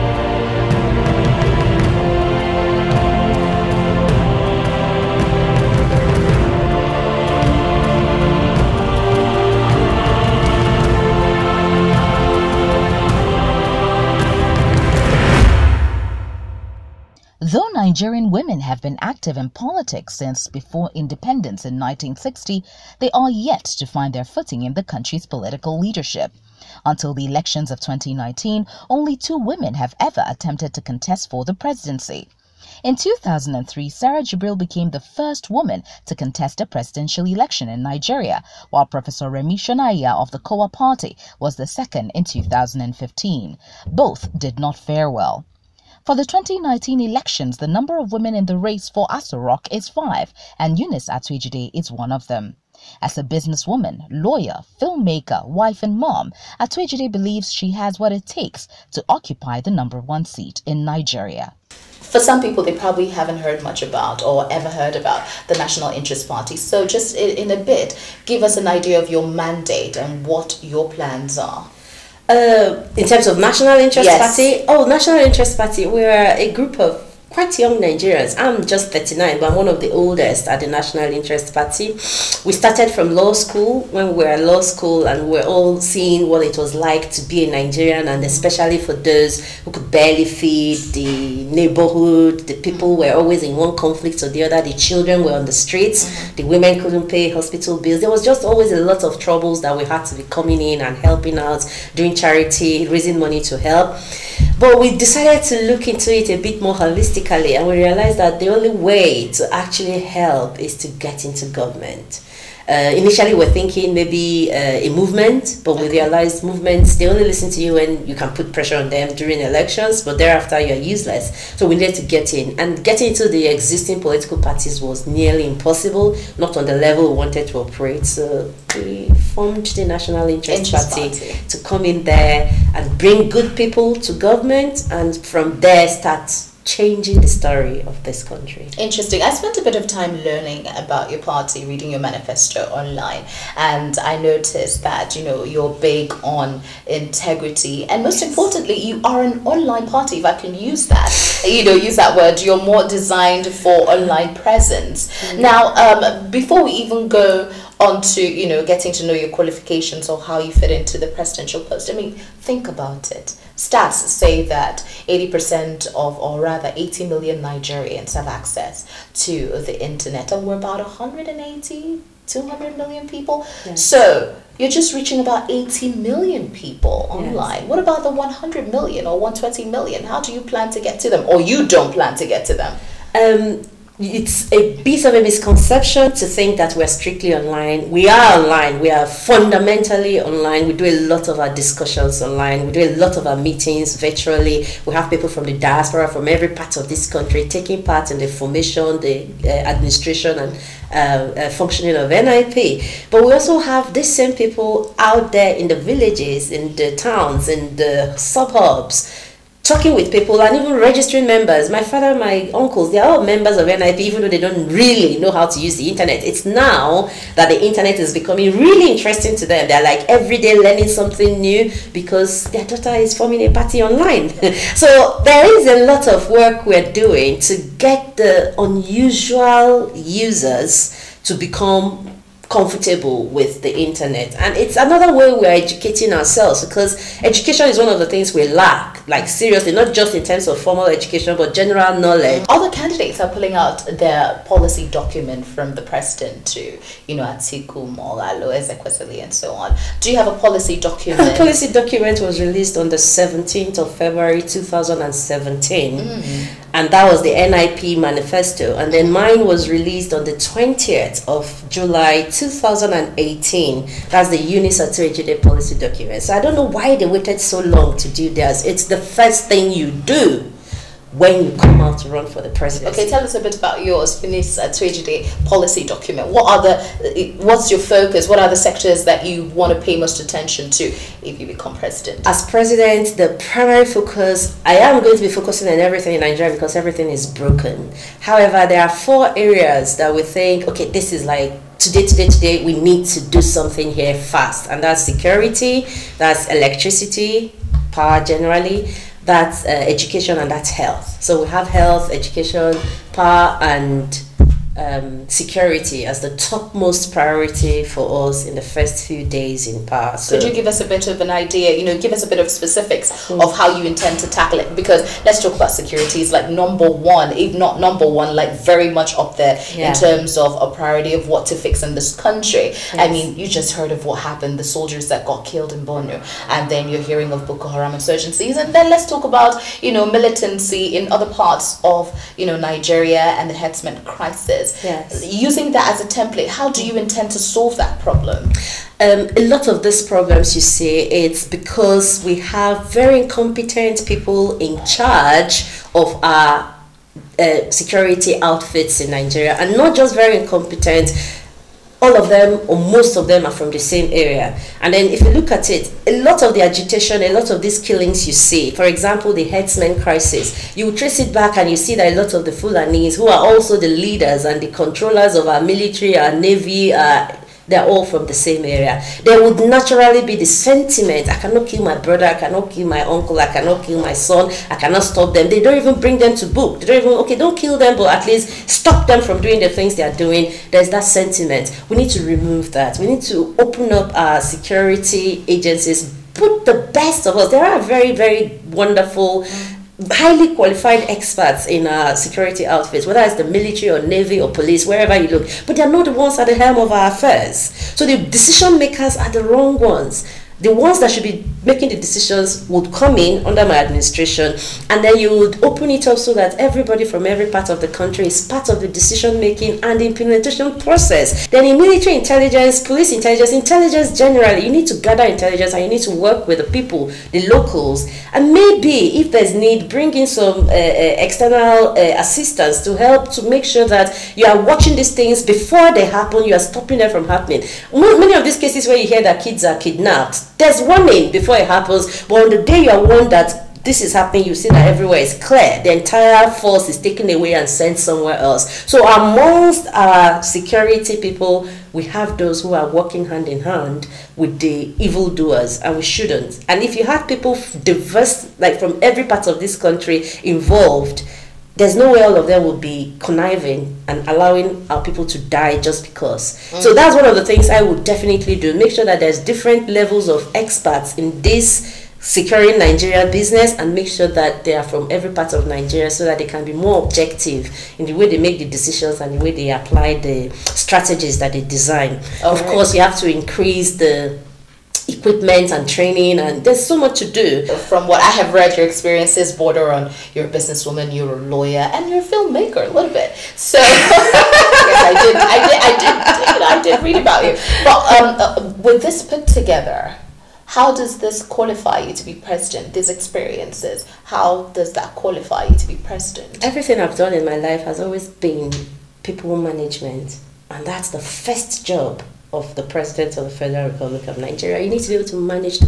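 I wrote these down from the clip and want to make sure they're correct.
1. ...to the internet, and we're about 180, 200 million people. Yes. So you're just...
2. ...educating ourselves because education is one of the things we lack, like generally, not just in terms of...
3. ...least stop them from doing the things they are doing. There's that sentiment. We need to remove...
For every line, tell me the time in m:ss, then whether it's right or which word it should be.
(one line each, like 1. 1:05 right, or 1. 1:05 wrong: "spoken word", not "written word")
1. 2:49 right
2. 3:55 wrong: "seriously", not "generally"
3. 6:18 right.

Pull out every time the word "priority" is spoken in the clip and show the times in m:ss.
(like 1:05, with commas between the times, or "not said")
5:07, 5:20.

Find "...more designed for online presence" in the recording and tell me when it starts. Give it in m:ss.
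2:32.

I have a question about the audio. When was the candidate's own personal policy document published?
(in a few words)
20 July 2018.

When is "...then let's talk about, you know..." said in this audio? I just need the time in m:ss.
5:28.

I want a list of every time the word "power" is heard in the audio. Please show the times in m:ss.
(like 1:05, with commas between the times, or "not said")
4:57, 5:03, 5:09.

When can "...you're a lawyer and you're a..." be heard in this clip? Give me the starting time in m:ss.
8:01.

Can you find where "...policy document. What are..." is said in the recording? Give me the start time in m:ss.
4:35.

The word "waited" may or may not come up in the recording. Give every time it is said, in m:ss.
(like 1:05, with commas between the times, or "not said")
4:27.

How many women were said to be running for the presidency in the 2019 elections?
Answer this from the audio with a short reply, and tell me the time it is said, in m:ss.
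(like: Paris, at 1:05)
5, at 0:49.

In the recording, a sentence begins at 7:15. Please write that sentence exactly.
The entire force is taken away and sent somewhere else.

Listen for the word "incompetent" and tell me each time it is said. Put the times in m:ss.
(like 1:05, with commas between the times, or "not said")
5:43, 5:50.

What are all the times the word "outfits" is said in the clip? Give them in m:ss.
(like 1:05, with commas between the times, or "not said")
5:48, 6:32.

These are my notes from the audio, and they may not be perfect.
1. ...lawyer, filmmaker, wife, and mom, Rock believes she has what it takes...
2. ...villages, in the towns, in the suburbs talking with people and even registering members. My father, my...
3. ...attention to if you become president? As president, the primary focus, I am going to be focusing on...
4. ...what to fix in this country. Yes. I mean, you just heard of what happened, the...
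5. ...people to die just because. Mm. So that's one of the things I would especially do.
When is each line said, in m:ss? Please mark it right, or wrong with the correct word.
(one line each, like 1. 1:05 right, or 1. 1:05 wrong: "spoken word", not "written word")
1. 0:54 wrong: "Atuejide", not "Rock"
2. 3:25 right
3. 4:40 right
4. 5:21 right
5. 7:35 wrong: "definitely", not "especially".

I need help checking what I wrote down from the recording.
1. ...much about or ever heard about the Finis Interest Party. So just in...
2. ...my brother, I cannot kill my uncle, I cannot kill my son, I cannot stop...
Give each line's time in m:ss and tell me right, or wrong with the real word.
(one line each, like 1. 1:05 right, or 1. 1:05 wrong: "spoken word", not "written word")
1. 1:03 wrong: "National", not "Finis"
2. 6:11 right.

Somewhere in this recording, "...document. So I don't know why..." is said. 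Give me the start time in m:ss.
4:25.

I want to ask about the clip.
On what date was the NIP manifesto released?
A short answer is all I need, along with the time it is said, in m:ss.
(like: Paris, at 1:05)
17 February 2017, at 4:12.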